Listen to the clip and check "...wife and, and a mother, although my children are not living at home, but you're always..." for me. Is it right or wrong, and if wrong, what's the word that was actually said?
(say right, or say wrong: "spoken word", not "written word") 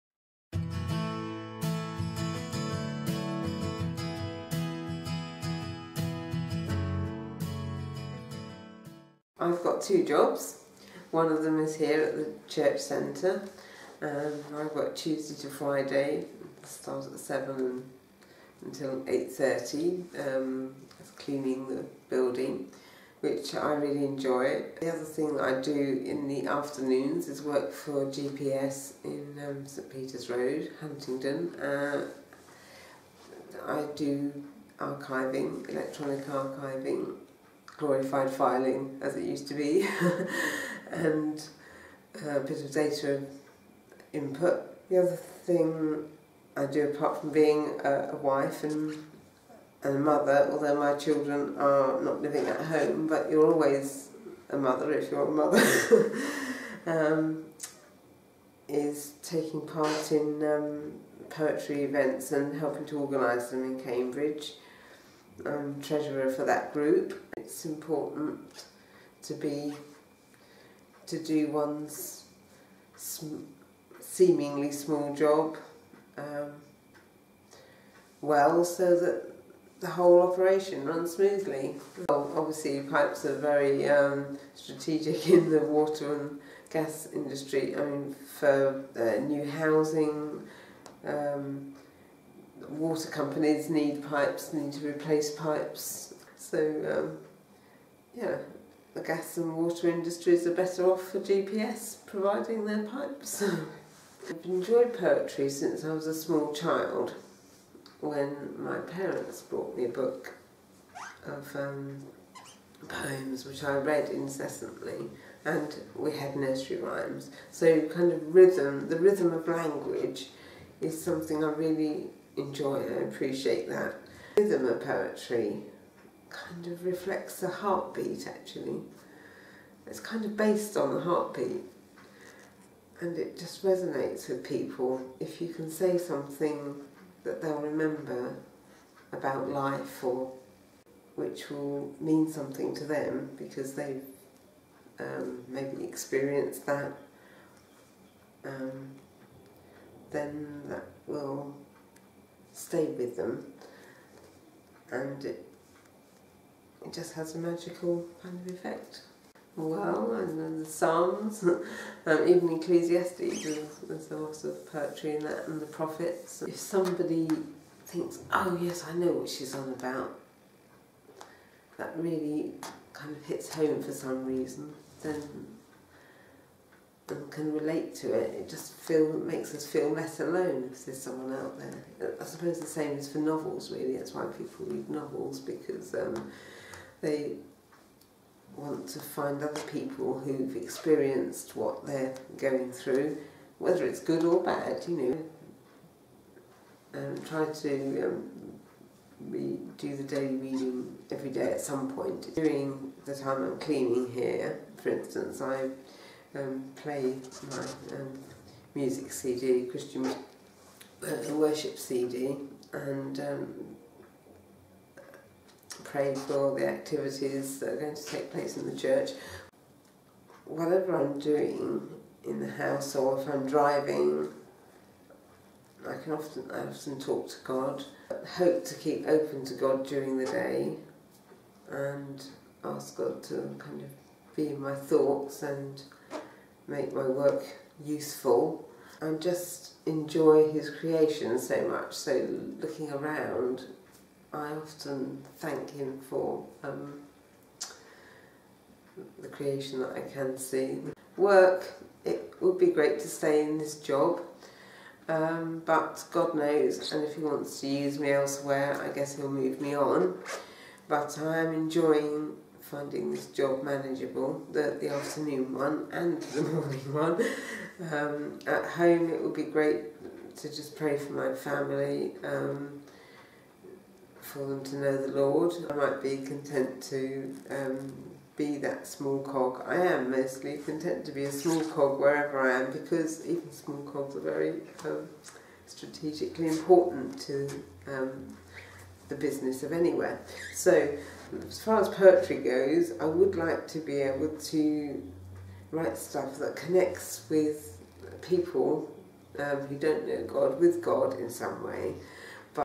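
right.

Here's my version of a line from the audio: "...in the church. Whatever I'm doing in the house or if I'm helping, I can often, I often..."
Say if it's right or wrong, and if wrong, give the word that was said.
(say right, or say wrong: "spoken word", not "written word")
wrong: "driving", not "helping".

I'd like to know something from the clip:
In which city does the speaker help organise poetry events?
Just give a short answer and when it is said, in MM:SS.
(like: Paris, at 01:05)
Cambridge, at 01:03.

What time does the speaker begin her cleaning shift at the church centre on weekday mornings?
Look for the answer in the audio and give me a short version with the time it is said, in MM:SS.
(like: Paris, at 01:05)
7, at 00:16.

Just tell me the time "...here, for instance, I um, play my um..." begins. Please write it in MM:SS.
03:24.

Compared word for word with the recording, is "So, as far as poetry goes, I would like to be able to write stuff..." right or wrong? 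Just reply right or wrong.
right.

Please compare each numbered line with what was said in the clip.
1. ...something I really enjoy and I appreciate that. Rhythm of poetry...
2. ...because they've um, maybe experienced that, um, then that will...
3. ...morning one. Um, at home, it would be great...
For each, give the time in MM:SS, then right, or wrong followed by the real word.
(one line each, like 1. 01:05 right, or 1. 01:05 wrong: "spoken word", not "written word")
1. 02:01 right
2. 02:23 right
3. 04:26 right.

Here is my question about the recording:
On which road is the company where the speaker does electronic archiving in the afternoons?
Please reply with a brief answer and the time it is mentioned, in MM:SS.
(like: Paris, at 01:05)
St Peter's Road, at 00:29.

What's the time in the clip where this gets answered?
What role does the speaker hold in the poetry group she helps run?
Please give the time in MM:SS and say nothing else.
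01:05.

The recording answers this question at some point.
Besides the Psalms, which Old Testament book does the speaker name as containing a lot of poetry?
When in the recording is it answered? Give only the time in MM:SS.
02:42.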